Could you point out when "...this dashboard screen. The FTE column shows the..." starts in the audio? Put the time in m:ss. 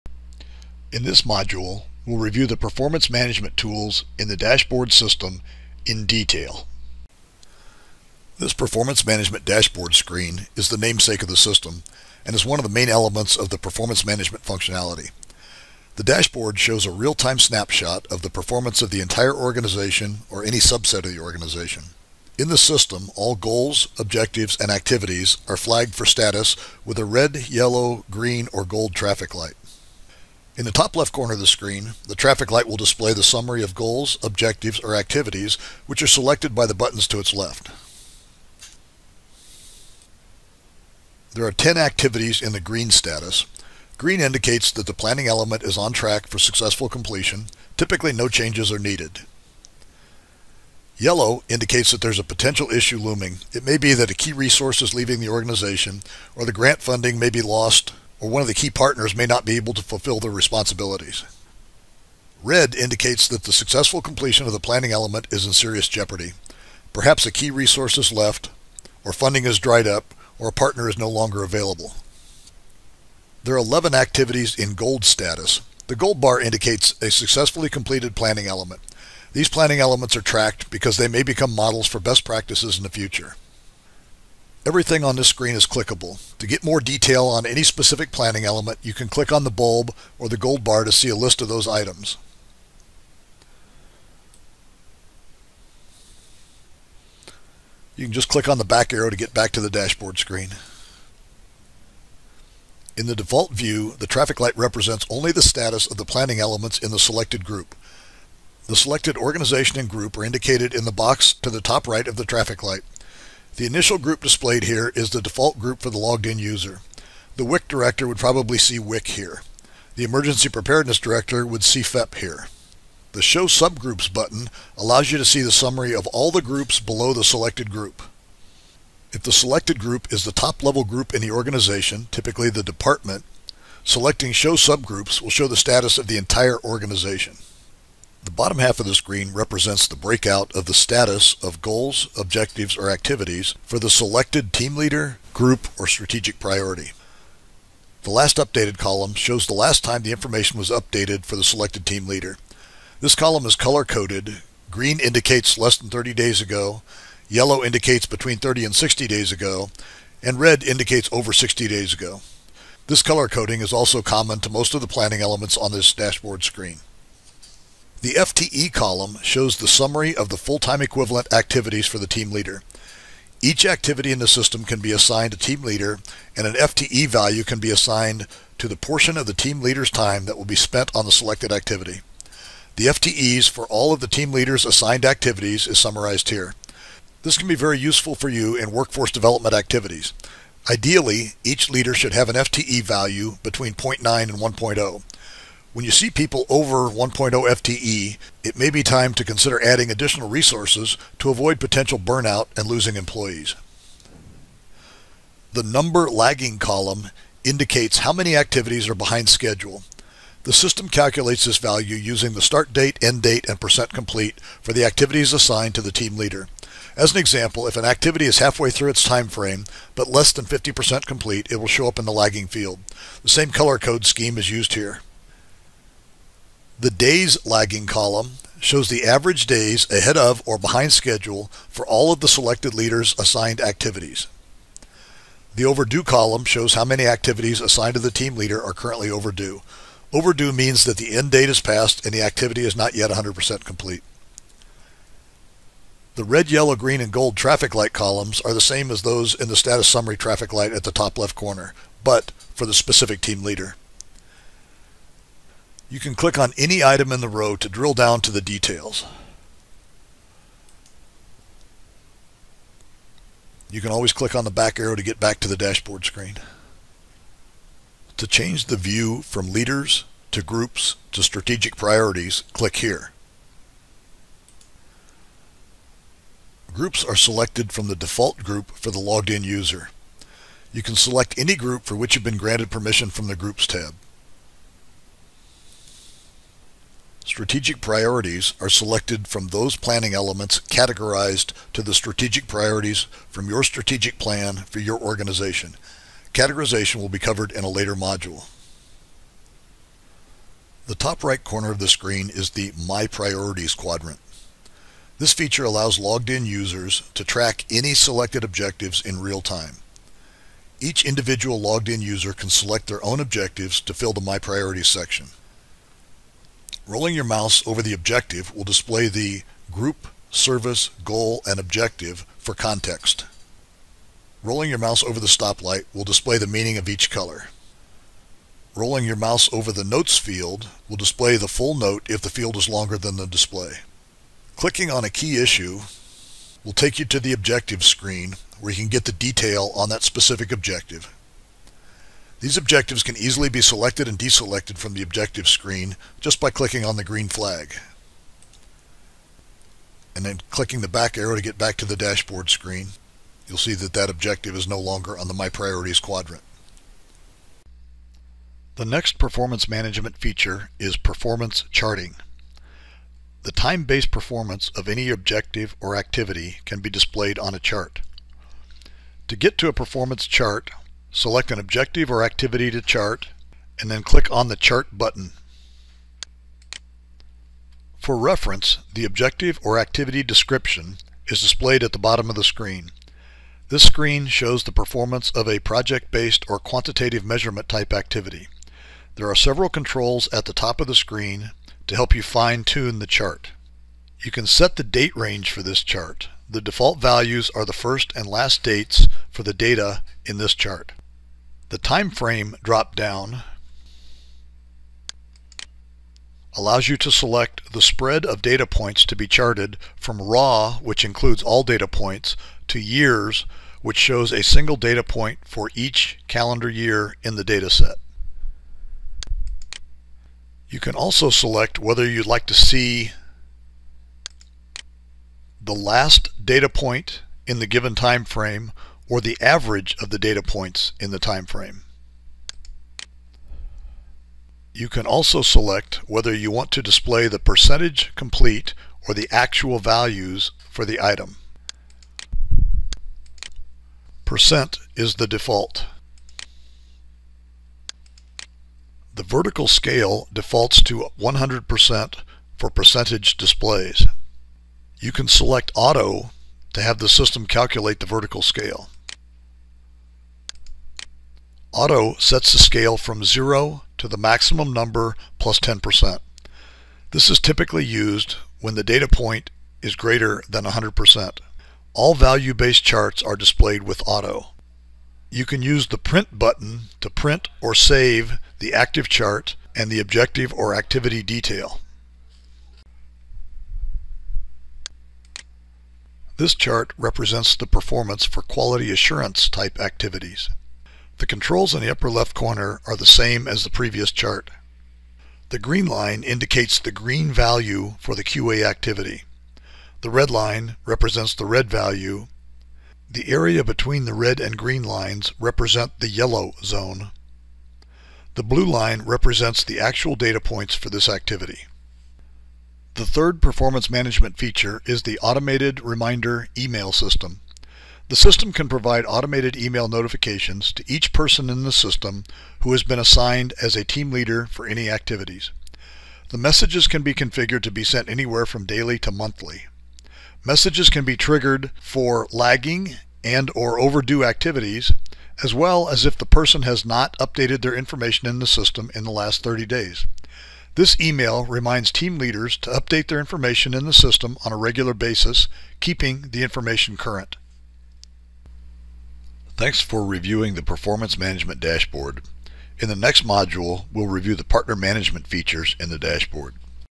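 2:45.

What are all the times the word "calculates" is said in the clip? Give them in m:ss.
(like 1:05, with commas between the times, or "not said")
3:30, 7:37.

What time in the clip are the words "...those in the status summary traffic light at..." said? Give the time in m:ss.
4:09.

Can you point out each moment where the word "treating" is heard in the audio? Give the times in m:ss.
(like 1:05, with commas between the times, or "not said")
not said.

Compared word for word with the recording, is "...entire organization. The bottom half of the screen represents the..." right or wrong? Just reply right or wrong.
right.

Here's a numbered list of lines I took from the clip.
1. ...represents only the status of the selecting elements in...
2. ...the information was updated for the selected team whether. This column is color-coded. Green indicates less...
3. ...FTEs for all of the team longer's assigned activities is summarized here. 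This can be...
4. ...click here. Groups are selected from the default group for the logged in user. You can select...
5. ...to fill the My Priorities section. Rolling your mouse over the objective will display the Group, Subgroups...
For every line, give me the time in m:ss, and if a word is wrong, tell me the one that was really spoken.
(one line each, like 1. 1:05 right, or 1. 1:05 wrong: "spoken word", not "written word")
1. 1:44 wrong: "planning", not "selecting"
2. 2:30 wrong: "leader", not "whether"
3. 3:02 wrong: "leader", not "longer"
4. 4:32 right
5. 5:13 wrong: "Service", not "Subgroups".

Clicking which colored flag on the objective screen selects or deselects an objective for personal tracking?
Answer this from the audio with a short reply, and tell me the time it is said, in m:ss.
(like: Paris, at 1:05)
green flag, at 5:47.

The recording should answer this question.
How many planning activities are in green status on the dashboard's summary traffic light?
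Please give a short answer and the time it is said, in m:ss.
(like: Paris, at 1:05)
10, at 0:41.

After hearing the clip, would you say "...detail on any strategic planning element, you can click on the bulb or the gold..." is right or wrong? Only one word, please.
wrong.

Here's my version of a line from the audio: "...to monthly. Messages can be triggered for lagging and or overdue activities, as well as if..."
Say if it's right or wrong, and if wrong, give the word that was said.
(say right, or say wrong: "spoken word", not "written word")
right.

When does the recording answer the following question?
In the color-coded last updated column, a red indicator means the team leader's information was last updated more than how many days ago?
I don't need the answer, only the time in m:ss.
2:41.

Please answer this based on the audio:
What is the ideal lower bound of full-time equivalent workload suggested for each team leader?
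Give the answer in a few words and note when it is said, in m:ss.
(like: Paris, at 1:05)
0.9, at 3:13.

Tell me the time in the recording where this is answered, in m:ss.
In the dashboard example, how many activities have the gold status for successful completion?
1:13.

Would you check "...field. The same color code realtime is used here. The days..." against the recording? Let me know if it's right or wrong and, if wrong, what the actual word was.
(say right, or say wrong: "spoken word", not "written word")
wrong: "scheme", not "realtime".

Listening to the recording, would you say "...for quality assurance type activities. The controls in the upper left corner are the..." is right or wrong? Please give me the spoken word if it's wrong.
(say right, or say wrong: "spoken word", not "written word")
right.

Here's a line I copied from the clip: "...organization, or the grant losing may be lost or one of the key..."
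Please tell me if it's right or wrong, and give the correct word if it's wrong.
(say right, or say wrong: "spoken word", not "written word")
wrong: "funding", not "losing".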